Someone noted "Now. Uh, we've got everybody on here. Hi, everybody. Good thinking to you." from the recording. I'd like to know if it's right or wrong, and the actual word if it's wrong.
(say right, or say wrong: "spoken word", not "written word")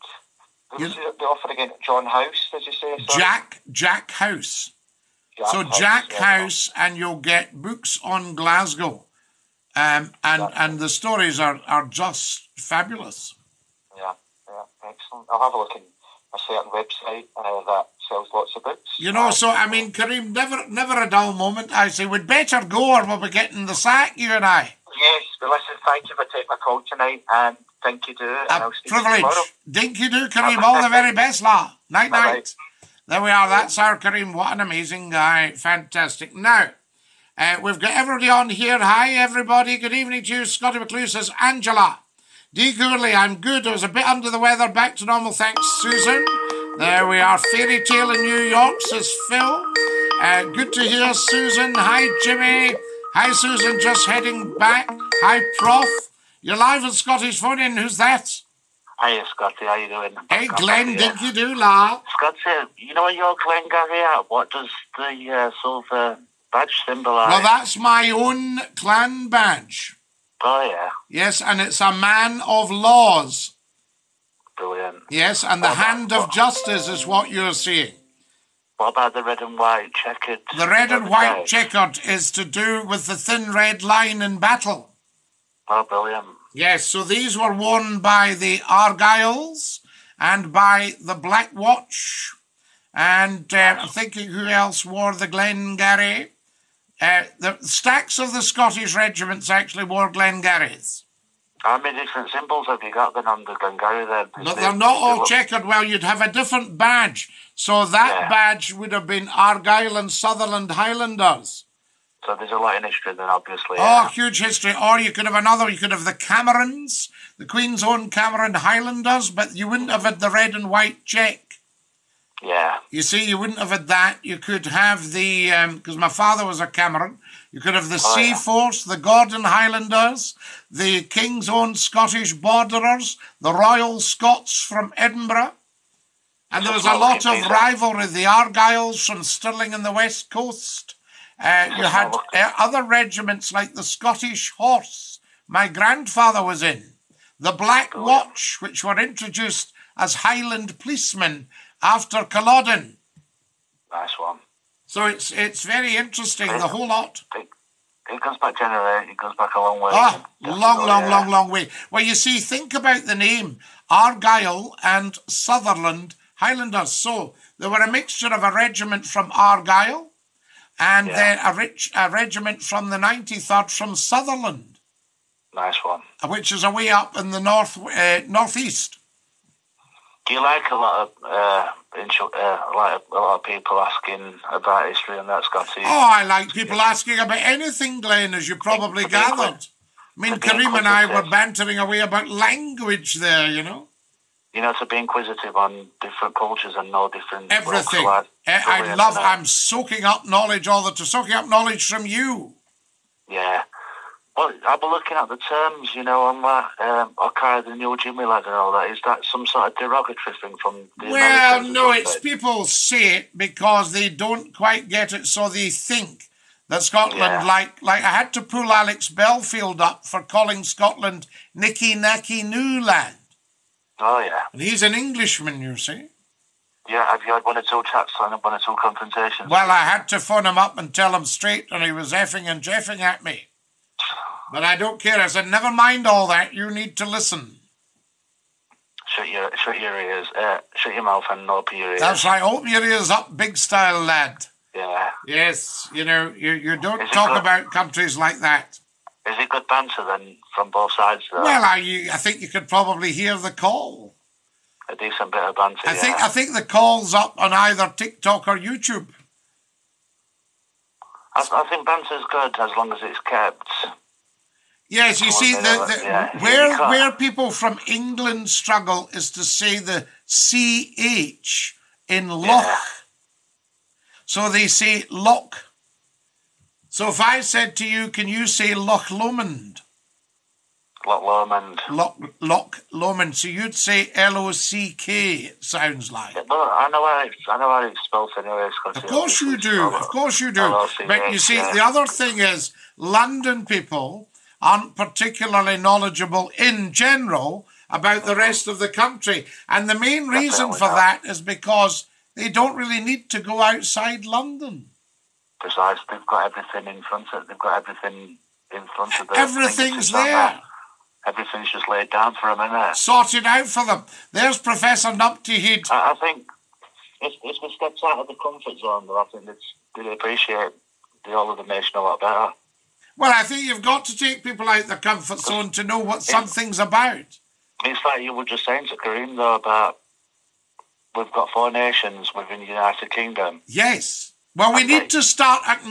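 wrong: "evening", not "thinking".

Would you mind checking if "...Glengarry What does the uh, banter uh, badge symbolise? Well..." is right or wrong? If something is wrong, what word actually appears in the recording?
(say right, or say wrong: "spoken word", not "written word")
wrong: "silver", not "banter".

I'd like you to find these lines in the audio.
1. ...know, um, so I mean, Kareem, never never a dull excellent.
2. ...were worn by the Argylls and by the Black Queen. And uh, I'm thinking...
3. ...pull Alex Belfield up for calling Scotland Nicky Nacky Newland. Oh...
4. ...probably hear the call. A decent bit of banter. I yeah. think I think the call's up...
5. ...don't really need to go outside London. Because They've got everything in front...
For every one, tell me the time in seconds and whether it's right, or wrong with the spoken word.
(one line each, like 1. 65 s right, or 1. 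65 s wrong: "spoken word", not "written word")
1. 19 s wrong: "moment", not "excellent"
2. 87 s wrong: "Watch", not "Queen"
3. 218 s right
4. 252 s right
5. 302 s right.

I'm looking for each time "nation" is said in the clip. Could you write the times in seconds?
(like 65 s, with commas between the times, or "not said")
321 s, 331 s.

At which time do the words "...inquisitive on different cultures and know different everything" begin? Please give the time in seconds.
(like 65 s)
194 s.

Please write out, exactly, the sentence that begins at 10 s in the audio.
and the stories are, are just fabulous.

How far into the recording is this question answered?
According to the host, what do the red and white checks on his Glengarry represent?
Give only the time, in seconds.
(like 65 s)
83 s.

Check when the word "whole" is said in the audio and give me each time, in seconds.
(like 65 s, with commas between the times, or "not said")
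156 s, 321 s.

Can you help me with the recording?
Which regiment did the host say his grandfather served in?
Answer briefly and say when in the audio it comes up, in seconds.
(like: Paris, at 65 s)
Scottish Horse, at 143 s.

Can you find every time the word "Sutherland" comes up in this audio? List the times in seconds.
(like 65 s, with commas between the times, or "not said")
110 s, 165 s, 173 s.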